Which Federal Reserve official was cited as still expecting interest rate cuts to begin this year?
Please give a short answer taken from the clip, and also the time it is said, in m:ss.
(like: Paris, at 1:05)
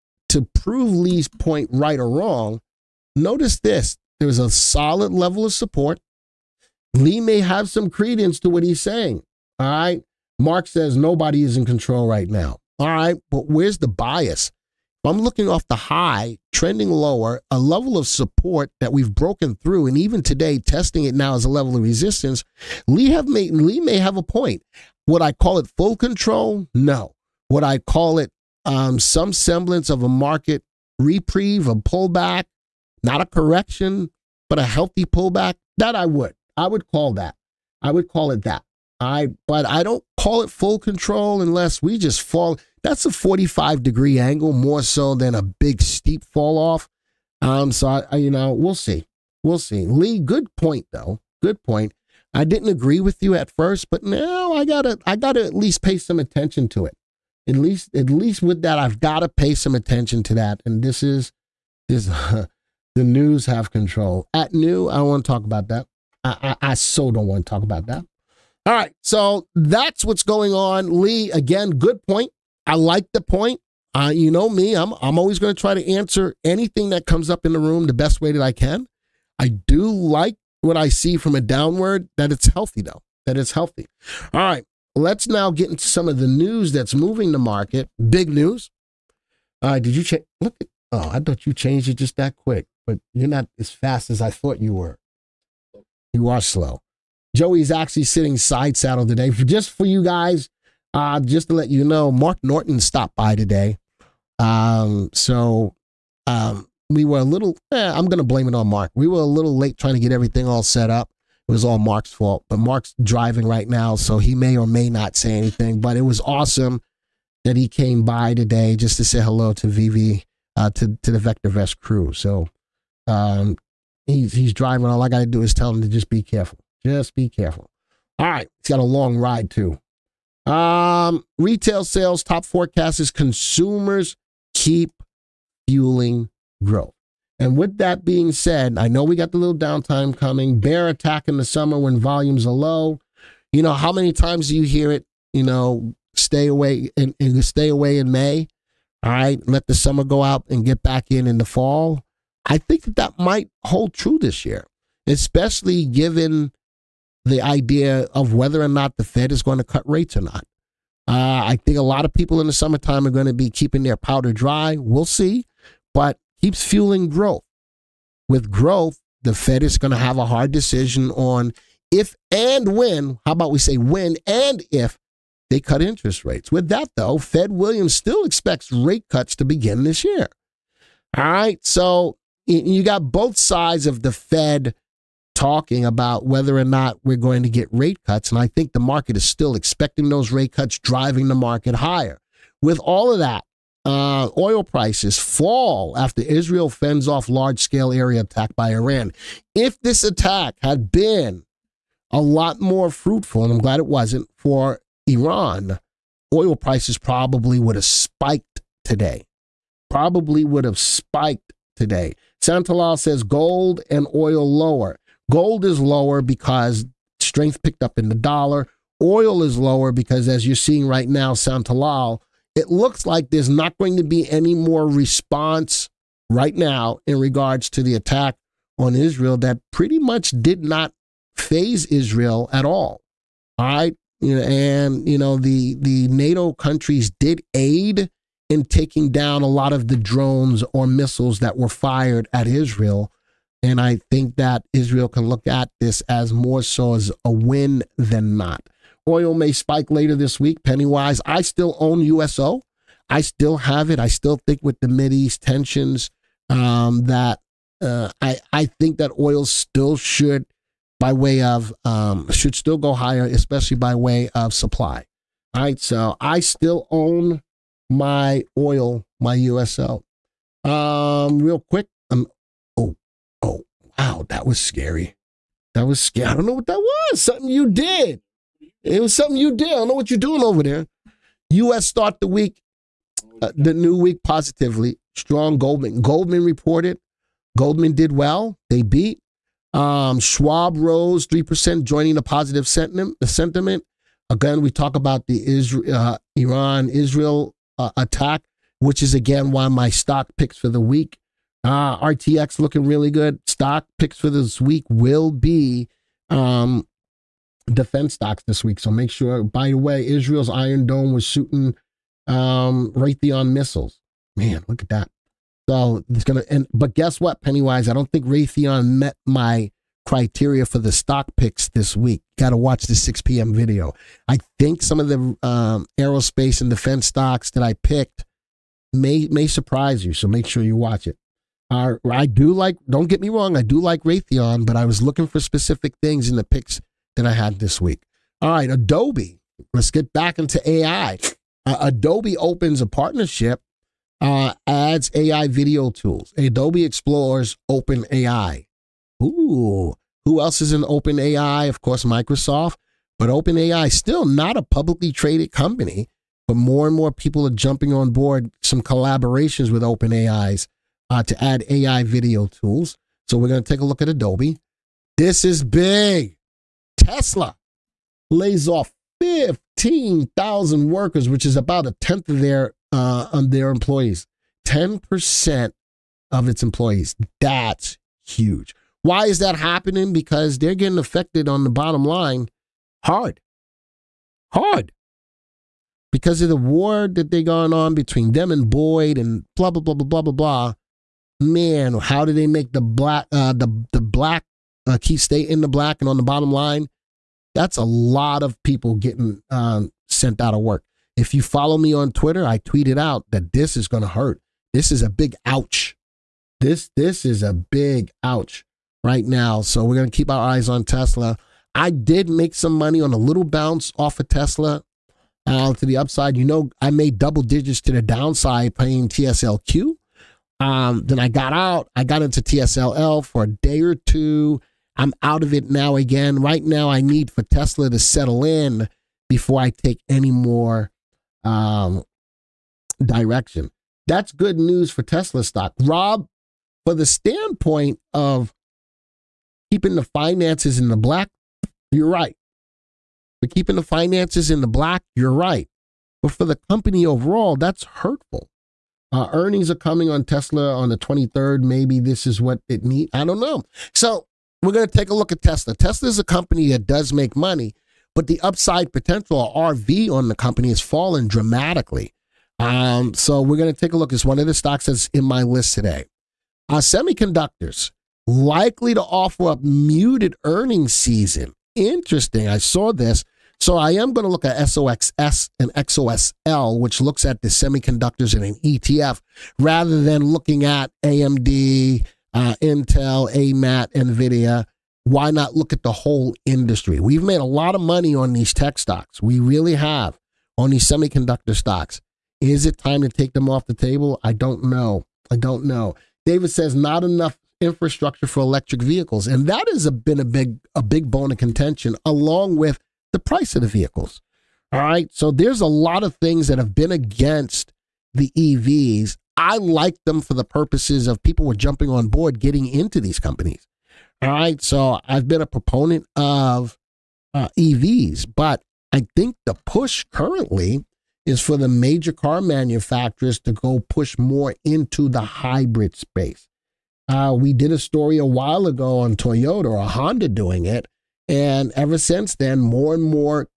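Williams, at 2:57.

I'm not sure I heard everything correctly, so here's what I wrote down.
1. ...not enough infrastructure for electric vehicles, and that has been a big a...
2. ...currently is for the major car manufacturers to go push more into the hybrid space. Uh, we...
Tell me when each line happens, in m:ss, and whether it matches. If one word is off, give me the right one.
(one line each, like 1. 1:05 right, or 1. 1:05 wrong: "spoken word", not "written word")
1. 8:16 right
2. 8:40 right.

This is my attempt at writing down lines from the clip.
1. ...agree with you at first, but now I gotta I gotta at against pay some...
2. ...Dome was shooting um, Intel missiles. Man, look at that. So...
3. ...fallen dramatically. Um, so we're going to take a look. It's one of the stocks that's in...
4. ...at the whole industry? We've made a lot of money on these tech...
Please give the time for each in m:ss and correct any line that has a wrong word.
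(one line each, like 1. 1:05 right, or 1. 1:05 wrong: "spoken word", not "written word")
1. 0:52 wrong: "least", not "against"
2. 5:10 wrong: "Raytheon", not "Intel"
3. 7:40 right
4. 8:05 right.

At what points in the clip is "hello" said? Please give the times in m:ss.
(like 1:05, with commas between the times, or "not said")
1:59.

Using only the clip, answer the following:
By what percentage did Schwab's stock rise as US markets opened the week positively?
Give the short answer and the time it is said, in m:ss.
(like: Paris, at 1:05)
3%, at 4:51.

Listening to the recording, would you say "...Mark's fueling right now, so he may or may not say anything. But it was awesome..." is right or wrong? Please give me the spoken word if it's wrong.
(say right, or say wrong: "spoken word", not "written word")
wrong: "driving", not "fueling".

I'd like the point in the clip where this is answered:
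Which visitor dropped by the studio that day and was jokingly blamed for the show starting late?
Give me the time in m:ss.
1:42.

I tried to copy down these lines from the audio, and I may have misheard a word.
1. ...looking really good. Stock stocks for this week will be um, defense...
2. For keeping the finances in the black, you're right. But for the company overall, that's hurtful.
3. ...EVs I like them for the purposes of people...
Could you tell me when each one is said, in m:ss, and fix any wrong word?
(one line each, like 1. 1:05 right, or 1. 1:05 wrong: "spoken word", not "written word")
1. 5:02 wrong: "picks", not "stocks"
2. 7:23 right
3. 8:28 right.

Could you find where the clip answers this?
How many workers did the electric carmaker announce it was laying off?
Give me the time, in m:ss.
6:09.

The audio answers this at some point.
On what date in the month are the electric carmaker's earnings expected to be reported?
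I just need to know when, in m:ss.
7:30.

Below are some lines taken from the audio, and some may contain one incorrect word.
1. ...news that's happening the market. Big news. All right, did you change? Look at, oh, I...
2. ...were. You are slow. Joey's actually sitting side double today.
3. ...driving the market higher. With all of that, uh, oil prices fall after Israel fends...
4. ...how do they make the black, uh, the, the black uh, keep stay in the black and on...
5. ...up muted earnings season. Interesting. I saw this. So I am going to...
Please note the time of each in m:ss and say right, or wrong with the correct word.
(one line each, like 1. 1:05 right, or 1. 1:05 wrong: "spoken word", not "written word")
1. 1:26 wrong: "moving", not "happening"
2. 1:34 wrong: "saddle", not "double"
3. 3:10 right
4. 6:31 right
5. 7:49 right.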